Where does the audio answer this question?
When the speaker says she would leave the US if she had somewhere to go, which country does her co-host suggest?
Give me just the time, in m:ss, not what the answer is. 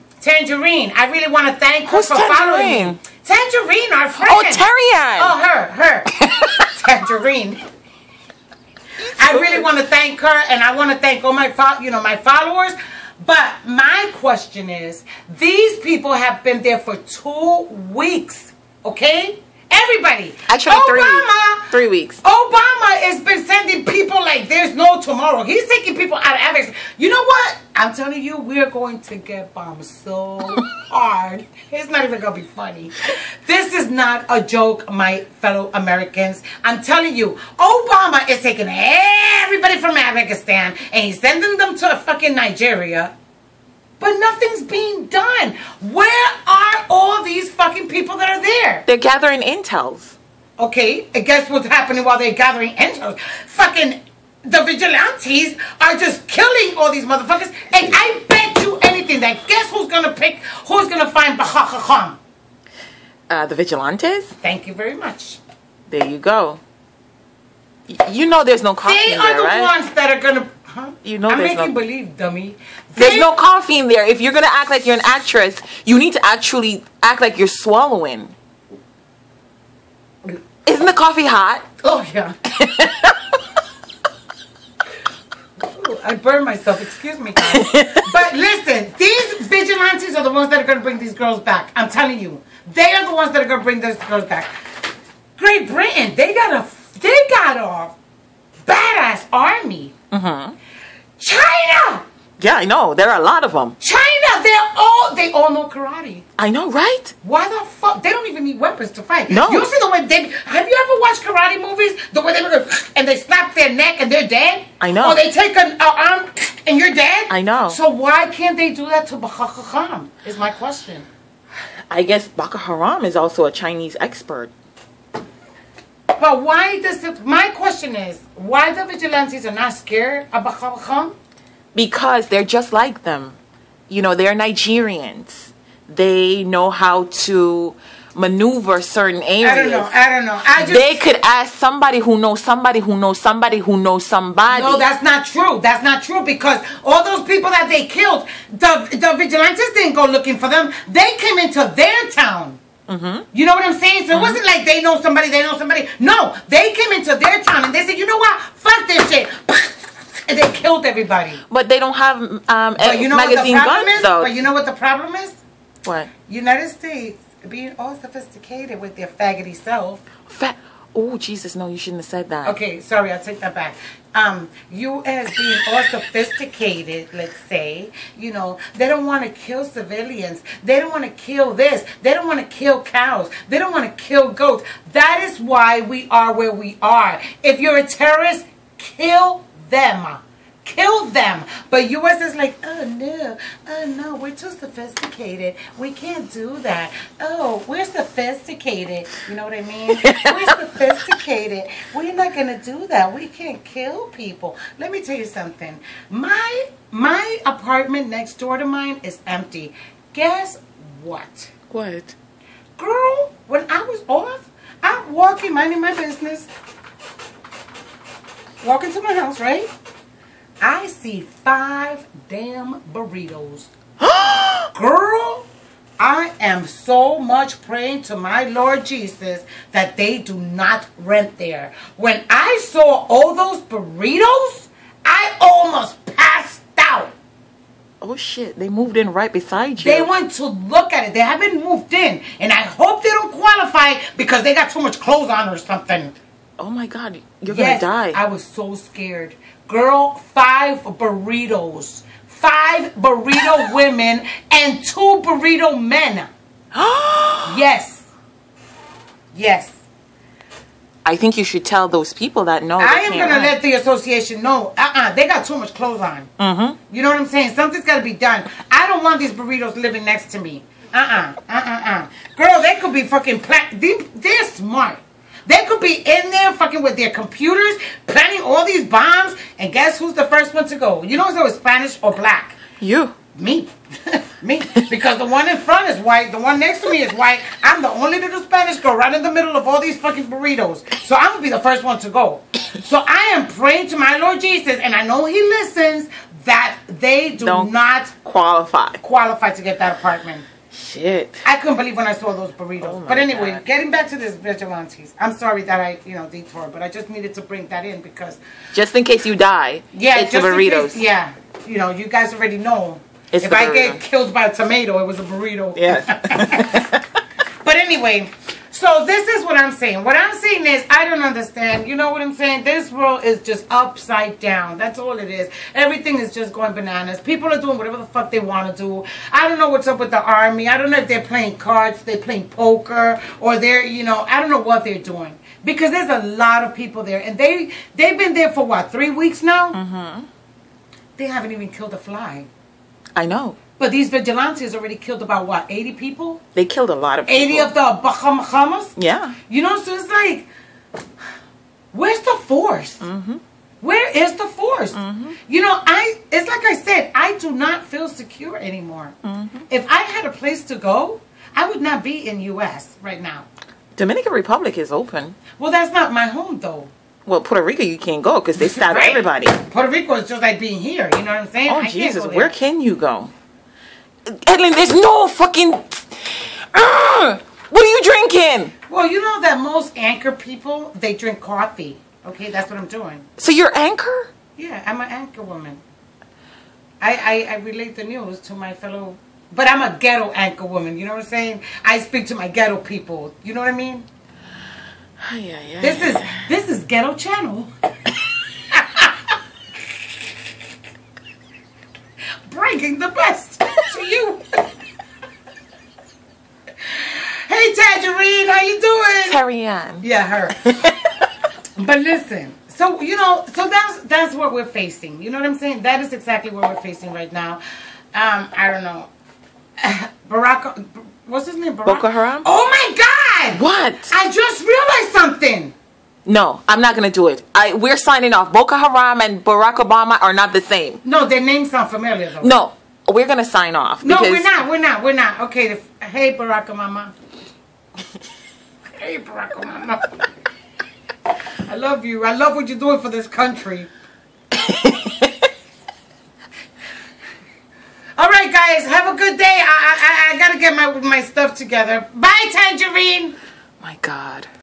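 6:03.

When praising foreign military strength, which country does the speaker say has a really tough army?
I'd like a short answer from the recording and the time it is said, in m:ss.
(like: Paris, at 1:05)
Great Britain, at 1:35.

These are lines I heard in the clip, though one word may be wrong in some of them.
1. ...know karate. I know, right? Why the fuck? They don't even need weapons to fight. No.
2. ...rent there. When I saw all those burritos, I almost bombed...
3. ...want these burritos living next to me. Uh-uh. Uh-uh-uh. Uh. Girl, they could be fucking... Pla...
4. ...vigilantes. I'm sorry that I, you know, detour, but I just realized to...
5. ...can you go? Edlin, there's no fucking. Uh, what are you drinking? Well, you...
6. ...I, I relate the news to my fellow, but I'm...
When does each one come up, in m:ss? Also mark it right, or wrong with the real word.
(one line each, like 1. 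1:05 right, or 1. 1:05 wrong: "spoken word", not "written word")
1. 1:45 right
2. 3:50 wrong: "passed", not "bombed"
3. 4:29 right
4. 5:04 wrong: "needed", not "realized"
5. 6:12 right
6. 6:27 right.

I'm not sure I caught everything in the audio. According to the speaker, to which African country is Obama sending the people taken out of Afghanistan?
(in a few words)
Nigeria.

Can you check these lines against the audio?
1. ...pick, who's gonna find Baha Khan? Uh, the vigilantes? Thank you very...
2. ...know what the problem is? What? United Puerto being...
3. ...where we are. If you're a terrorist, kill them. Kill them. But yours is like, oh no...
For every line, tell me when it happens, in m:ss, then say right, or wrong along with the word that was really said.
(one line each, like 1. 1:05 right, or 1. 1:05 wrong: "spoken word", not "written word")
1. 1:00 right
2. 2:44 wrong: "States", not "Puerto"
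3. 3:06 right.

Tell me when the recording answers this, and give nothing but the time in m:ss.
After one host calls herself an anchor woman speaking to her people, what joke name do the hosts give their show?
6:36.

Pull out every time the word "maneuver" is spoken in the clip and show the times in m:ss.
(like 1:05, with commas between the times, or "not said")
2:18.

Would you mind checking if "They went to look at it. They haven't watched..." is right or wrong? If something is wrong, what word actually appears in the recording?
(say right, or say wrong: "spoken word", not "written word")
wrong: "moved", not "watched".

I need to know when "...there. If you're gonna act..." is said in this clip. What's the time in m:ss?
1:13.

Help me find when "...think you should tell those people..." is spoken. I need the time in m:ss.
4:21.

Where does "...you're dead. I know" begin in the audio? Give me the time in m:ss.
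1:56.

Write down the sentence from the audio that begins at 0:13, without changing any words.
But my question is, these people have been there for two weeks, okay?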